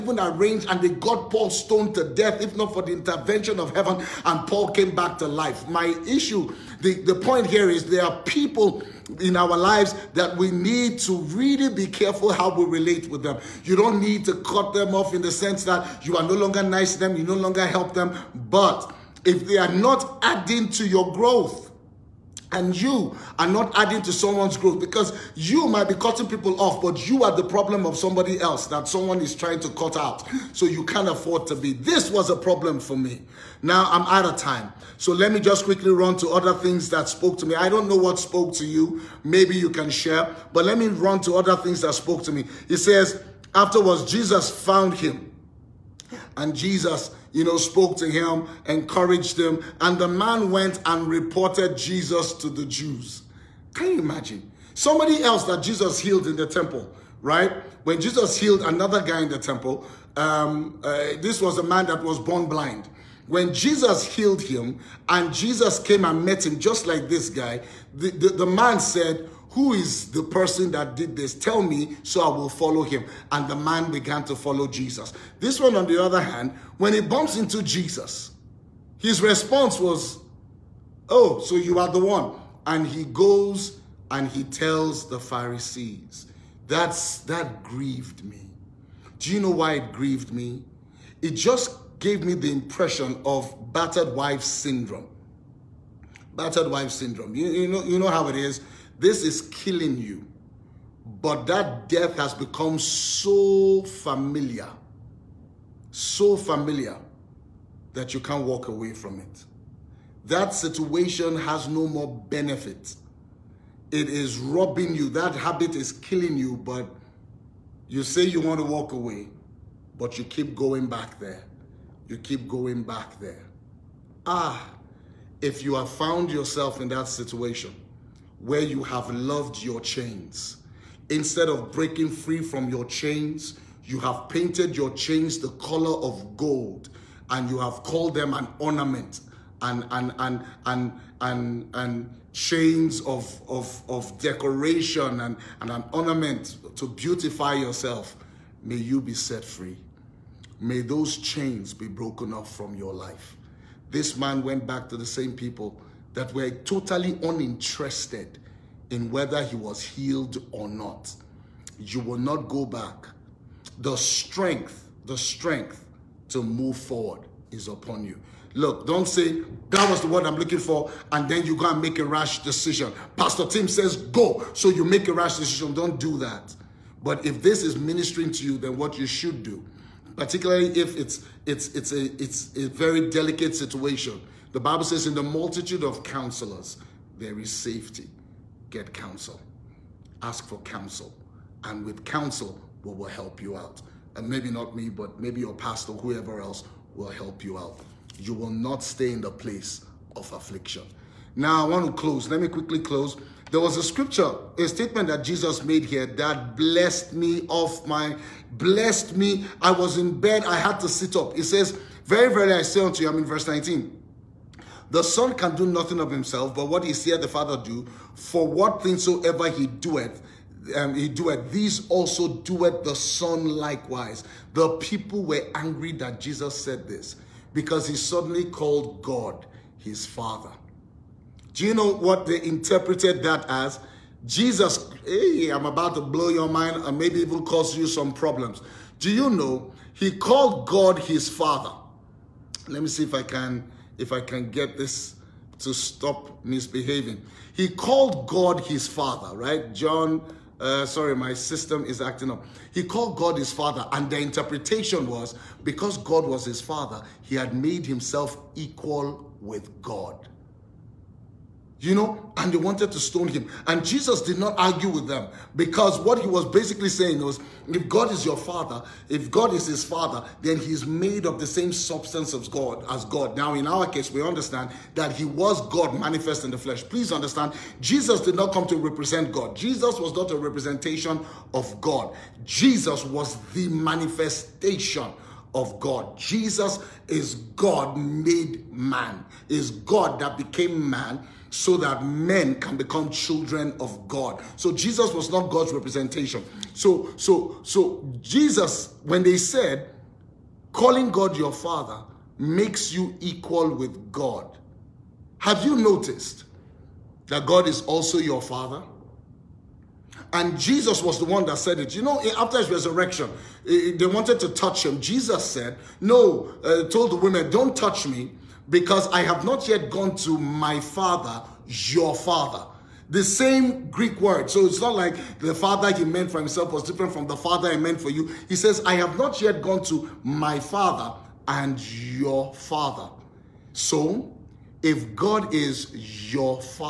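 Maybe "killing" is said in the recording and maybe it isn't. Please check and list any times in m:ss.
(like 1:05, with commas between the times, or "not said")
1:39, 1:55.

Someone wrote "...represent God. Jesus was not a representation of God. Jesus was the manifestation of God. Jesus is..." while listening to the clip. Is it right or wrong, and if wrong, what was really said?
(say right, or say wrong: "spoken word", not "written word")
right.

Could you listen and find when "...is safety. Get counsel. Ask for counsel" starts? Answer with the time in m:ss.
3:07.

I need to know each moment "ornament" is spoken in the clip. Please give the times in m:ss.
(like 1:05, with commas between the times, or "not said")
2:18, 2:25.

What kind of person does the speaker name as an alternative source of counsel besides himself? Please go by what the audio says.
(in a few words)
Your pastor.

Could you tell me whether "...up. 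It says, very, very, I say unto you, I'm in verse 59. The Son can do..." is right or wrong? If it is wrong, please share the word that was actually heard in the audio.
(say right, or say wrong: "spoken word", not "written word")
wrong: "19", not "59".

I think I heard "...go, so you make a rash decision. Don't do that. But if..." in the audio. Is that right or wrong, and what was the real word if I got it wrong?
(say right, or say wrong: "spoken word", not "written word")
right.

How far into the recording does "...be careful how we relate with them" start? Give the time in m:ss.
0:11.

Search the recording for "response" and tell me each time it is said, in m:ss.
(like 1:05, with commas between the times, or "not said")
1:19.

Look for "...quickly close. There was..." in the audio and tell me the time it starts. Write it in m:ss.
3:22.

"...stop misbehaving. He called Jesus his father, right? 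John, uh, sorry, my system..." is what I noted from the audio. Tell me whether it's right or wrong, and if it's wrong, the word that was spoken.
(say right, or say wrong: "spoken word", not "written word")
wrong: "God", not "Jesus".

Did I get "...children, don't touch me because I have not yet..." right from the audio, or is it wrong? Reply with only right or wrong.
wrong.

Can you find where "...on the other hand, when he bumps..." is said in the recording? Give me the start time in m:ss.
1:15.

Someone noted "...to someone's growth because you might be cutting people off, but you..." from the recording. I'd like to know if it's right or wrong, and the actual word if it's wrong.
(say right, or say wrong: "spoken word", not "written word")
right.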